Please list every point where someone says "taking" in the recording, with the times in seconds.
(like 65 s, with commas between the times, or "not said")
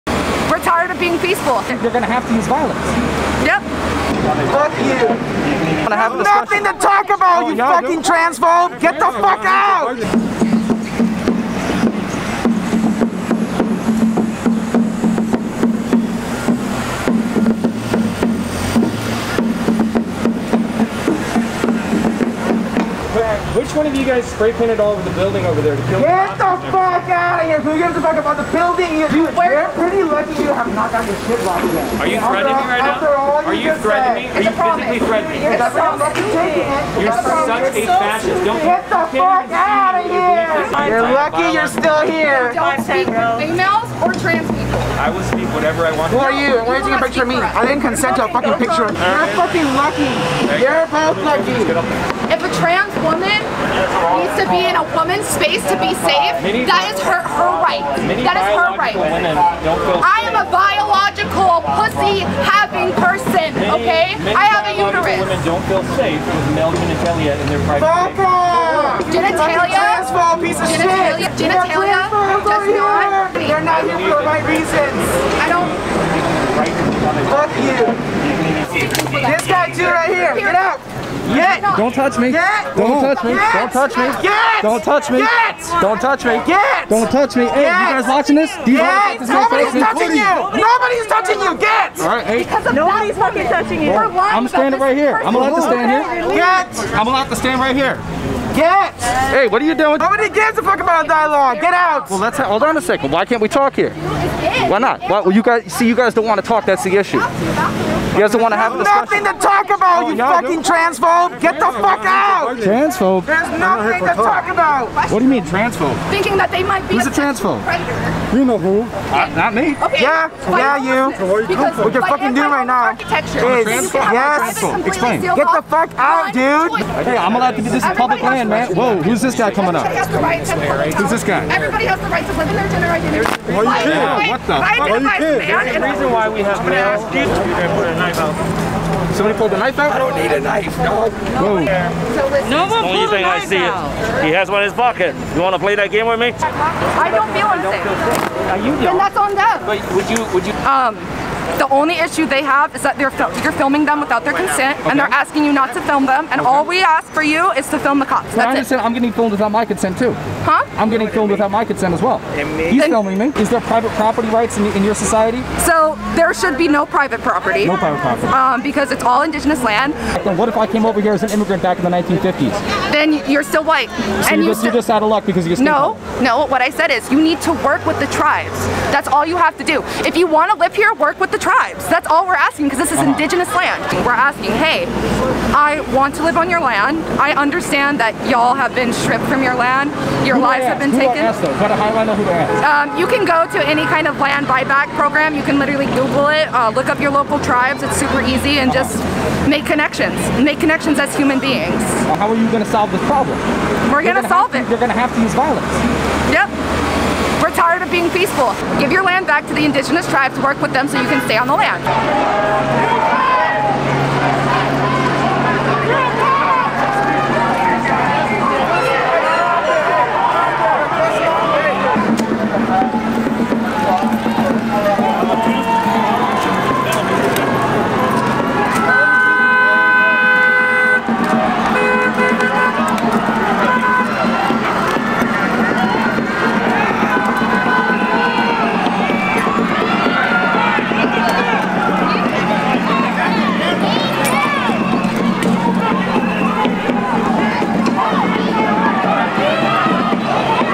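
46 s.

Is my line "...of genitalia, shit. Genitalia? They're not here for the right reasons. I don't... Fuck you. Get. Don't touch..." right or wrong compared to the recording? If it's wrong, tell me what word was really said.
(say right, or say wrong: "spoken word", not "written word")
right.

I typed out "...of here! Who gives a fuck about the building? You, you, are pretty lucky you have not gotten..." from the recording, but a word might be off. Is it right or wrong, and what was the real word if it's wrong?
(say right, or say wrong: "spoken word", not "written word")
right.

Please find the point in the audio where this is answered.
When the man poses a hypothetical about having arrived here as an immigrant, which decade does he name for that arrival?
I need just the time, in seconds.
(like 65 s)
171 s.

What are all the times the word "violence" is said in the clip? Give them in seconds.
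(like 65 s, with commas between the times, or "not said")
2 s, 205 s.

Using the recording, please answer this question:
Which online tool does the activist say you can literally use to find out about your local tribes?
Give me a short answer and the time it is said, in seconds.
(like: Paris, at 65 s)
Google, at 195 s.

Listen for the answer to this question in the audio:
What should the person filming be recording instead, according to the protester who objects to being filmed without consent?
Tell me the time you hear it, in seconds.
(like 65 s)
157 s.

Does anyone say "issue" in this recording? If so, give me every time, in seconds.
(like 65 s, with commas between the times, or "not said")
106 s, 151 s.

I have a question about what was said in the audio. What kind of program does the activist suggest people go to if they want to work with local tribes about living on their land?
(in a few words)
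land buyback program.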